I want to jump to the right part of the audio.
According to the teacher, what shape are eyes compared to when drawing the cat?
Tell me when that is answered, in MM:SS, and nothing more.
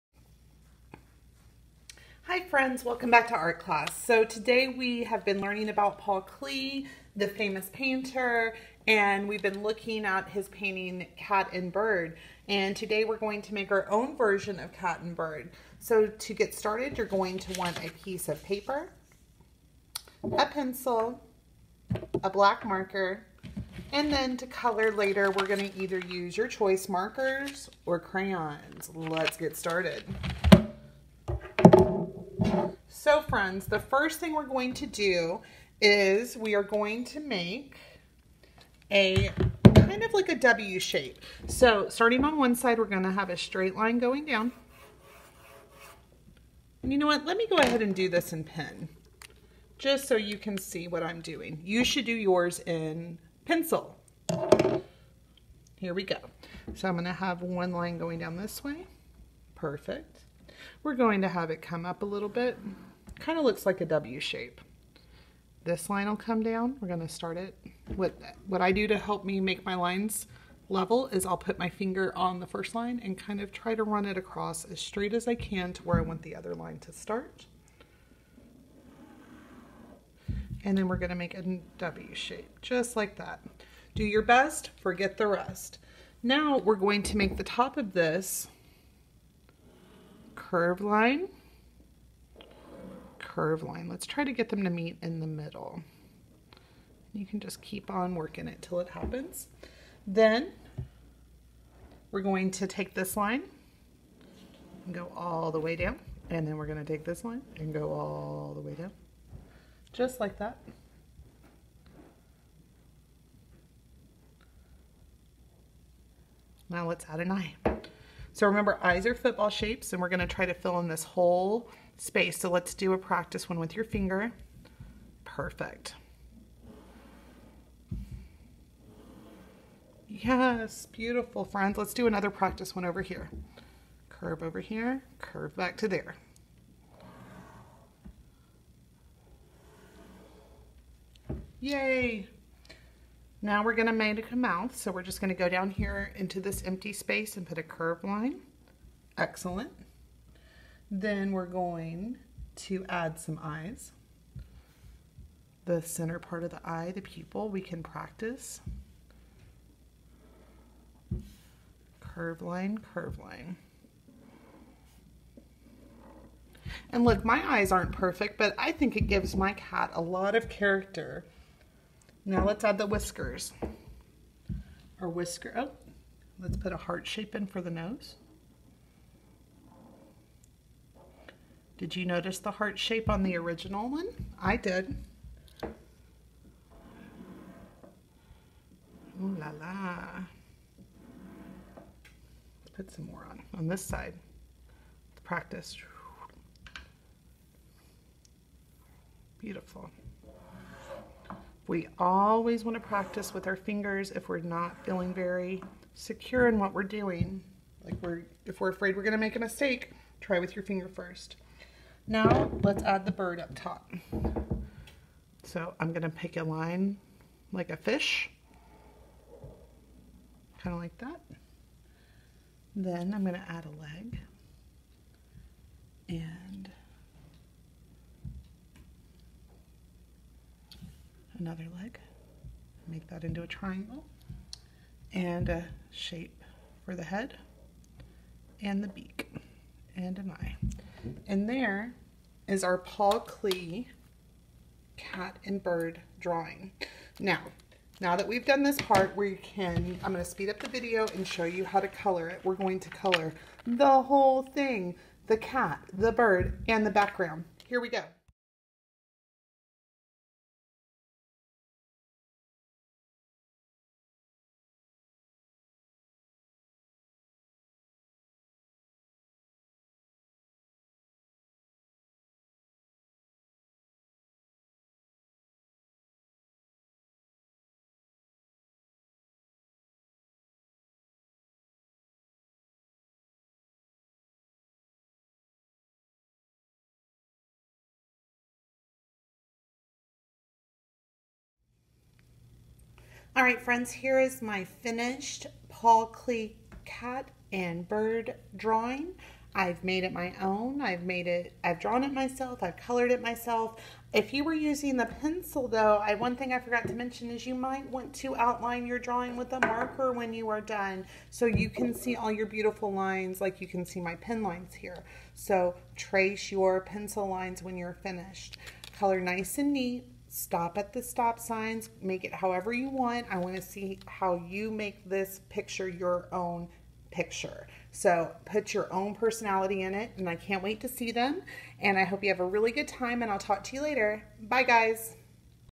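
01:59.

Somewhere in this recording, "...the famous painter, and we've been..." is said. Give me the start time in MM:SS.
00:07.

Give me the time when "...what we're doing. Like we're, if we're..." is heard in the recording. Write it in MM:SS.
03:26.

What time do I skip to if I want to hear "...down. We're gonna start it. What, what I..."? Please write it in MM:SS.
01:06.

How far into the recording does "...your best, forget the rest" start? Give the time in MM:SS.
01:24.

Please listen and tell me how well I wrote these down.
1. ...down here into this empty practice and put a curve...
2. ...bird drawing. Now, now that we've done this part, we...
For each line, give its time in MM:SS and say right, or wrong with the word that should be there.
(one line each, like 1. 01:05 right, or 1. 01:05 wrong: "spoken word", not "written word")
1. 02:25 wrong: "space", not "practice"
2. 04:05 right.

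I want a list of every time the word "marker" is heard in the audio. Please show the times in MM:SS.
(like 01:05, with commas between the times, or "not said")
00:22, 00:26, 05:09.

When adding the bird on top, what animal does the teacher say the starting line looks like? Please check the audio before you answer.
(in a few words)
A fish.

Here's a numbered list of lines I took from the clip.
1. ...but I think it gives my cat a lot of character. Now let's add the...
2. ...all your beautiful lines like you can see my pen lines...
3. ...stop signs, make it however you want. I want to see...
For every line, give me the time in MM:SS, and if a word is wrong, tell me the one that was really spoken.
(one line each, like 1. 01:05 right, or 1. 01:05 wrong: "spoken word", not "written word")
1. 02:48 right
2. 05:12 right
3. 05:21 right.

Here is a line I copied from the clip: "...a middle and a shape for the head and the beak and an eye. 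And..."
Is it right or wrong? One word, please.
wrong.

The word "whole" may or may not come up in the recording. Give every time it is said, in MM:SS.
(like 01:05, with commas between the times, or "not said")
02:01, 04:14.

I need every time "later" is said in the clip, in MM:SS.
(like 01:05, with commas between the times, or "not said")
00:24, 05:33.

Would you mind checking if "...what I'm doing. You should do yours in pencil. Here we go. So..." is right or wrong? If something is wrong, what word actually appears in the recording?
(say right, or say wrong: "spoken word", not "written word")
right.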